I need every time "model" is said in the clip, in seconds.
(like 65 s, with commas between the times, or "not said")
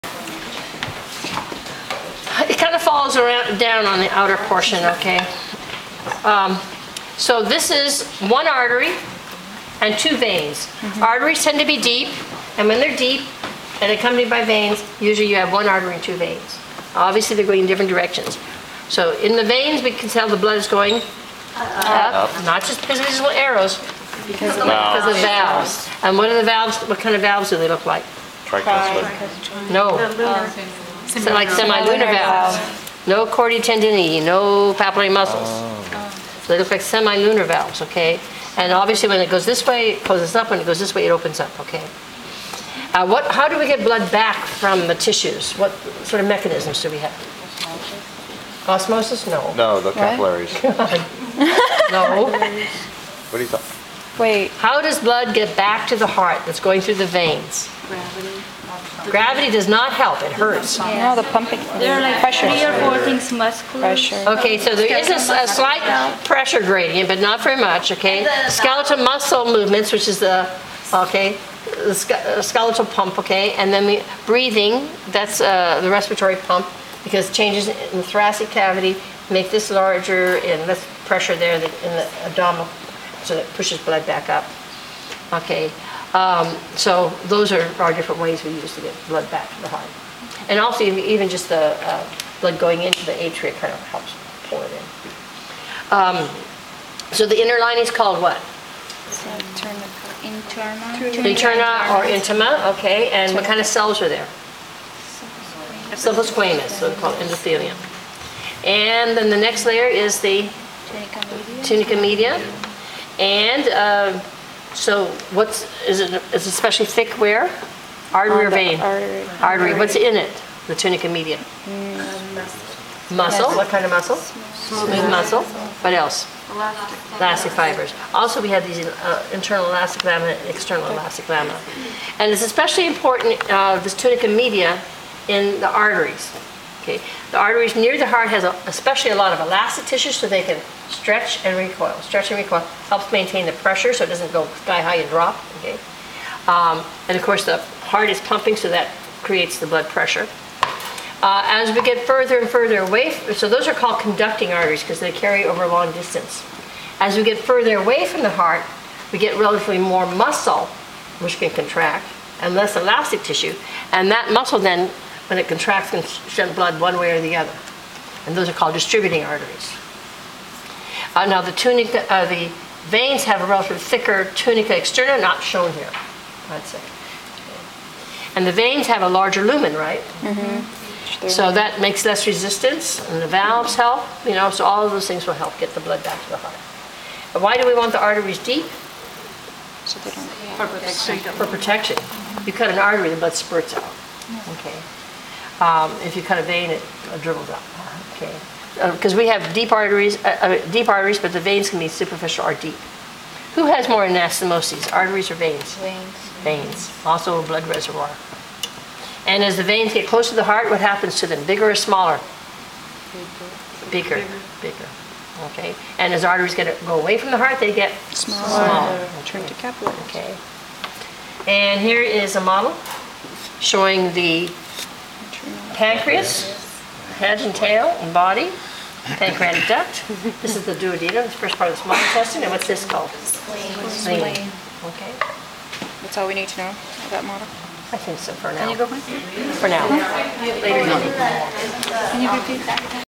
222 s, 237 s.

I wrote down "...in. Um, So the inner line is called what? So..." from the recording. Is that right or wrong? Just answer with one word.
right.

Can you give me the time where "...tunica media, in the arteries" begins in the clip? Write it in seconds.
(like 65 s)
133 s.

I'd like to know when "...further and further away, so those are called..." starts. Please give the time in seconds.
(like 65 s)
152 s.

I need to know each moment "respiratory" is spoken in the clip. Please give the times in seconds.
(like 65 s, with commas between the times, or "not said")
75 s.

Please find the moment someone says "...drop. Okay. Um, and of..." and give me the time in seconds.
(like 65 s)
145 s.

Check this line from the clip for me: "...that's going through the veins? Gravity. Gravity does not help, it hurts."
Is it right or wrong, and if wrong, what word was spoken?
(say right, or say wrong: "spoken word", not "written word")
right.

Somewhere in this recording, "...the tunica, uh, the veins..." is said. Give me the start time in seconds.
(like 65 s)
171 s.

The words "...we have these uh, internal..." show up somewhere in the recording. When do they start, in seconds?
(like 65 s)
128 s.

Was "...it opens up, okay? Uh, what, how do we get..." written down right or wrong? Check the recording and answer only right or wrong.
right.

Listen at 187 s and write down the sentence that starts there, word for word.
But why do we want the arteries deep?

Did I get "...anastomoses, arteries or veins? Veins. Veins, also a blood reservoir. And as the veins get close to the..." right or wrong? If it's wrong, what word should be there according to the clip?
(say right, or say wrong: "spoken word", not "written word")
right.